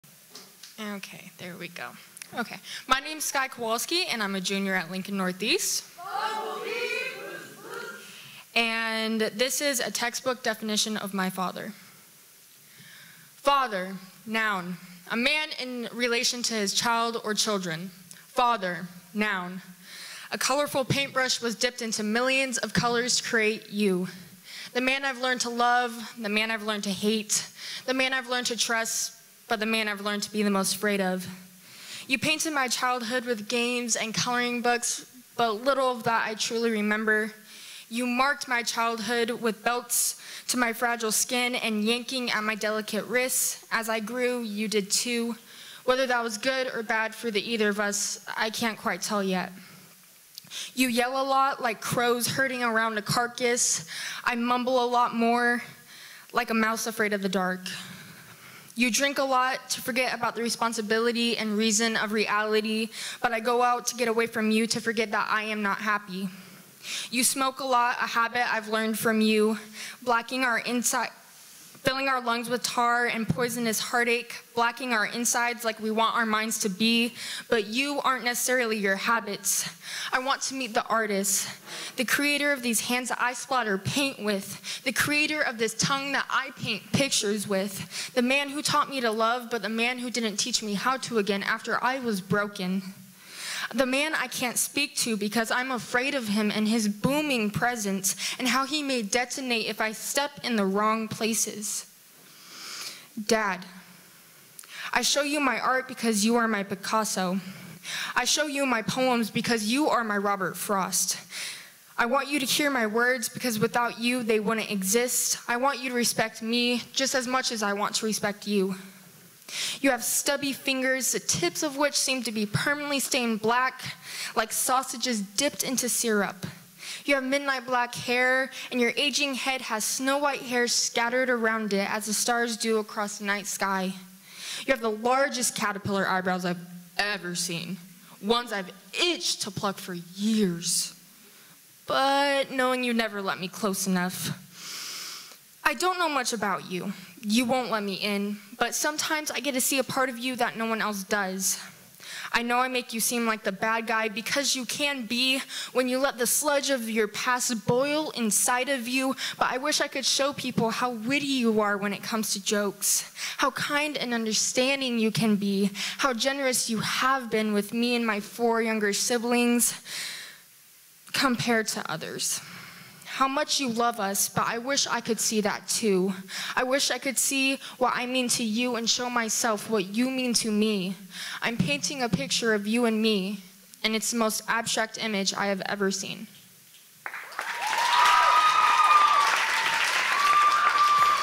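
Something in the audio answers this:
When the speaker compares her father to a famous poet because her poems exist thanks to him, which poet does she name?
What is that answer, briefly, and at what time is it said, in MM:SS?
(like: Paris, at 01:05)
Robert Frost, at 01:50.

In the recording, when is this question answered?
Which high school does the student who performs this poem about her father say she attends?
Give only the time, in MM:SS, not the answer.
00:04.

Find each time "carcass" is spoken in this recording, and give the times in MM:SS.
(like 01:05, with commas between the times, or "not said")
00:53.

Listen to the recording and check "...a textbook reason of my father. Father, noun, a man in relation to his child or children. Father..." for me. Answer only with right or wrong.
wrong.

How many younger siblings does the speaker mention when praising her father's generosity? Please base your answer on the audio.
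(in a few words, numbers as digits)
4.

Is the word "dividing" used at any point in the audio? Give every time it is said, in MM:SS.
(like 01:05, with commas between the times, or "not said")
not said.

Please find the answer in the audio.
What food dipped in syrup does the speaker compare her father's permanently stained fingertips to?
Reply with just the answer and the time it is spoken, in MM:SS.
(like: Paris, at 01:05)
Sausages, at 02:04.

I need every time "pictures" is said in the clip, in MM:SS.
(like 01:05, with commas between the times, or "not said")
01:26, 03:02.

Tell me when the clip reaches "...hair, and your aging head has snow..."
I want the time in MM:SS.
02:07.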